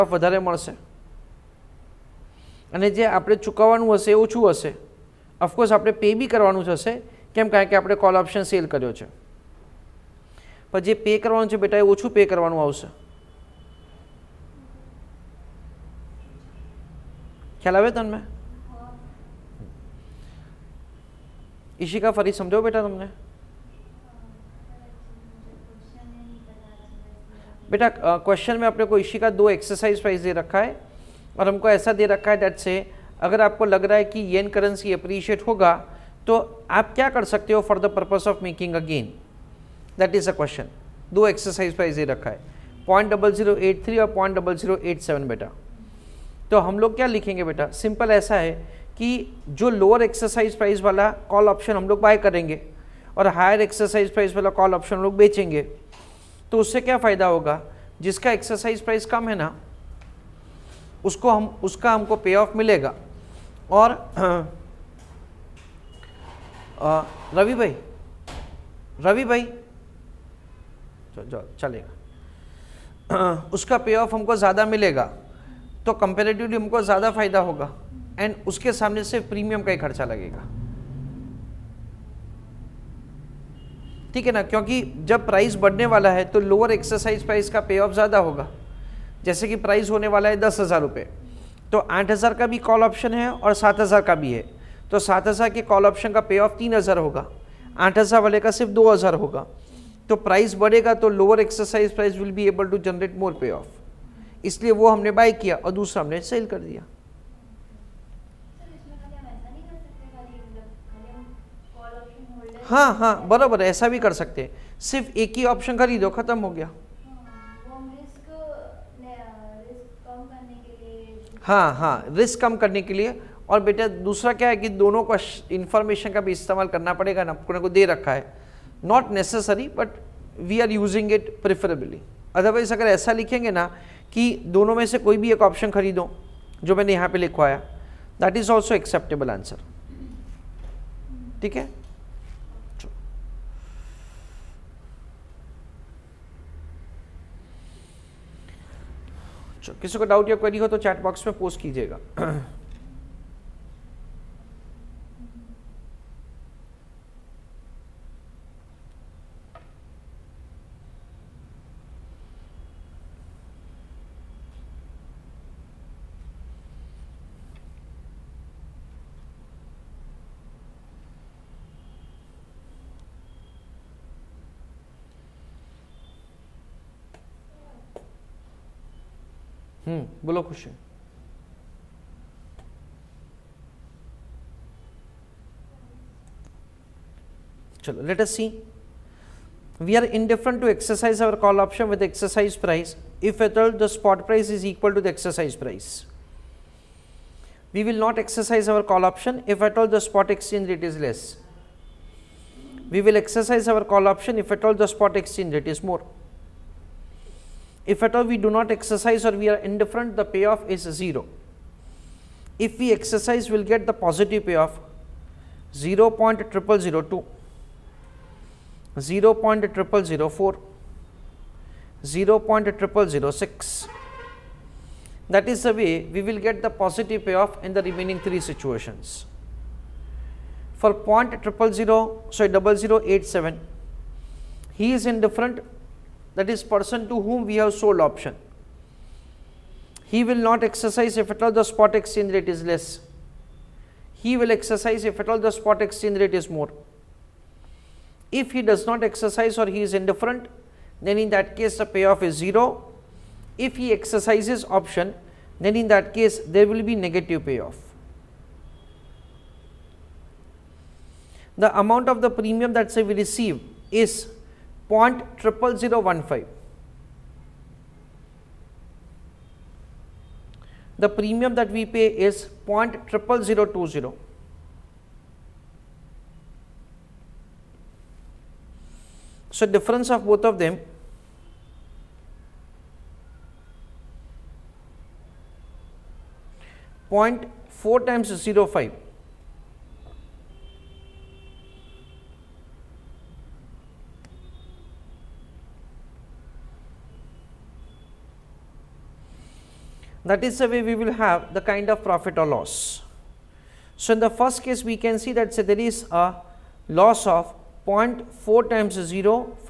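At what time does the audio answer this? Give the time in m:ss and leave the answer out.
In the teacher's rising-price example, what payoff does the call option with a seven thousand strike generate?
1:36.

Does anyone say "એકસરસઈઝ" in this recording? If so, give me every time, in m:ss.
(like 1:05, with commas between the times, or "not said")
0:29.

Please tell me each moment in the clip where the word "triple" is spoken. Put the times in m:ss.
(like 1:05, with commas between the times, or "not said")
3:51, 4:33.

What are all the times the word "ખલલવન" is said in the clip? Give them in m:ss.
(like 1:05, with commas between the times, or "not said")
0:17.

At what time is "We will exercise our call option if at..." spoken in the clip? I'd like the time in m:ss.
3:22.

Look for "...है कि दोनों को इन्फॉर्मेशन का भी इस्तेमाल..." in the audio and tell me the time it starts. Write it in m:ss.
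2:04.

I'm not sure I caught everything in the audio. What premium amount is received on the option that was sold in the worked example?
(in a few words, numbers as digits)
0.00015.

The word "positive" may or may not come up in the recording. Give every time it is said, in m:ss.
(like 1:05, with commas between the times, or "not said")
3:33, 3:46.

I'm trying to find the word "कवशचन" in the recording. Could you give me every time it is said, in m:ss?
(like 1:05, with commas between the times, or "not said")
0:40, 3:00.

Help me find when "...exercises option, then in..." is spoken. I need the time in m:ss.
4:13.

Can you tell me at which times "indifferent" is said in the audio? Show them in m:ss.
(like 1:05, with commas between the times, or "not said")
3:10, 3:29, 3:55, 4:09.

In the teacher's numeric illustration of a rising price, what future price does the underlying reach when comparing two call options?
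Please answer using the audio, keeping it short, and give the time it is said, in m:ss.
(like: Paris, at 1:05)
10,000 rupees, at 1:30.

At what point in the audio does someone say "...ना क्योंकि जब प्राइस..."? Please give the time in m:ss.
1:24.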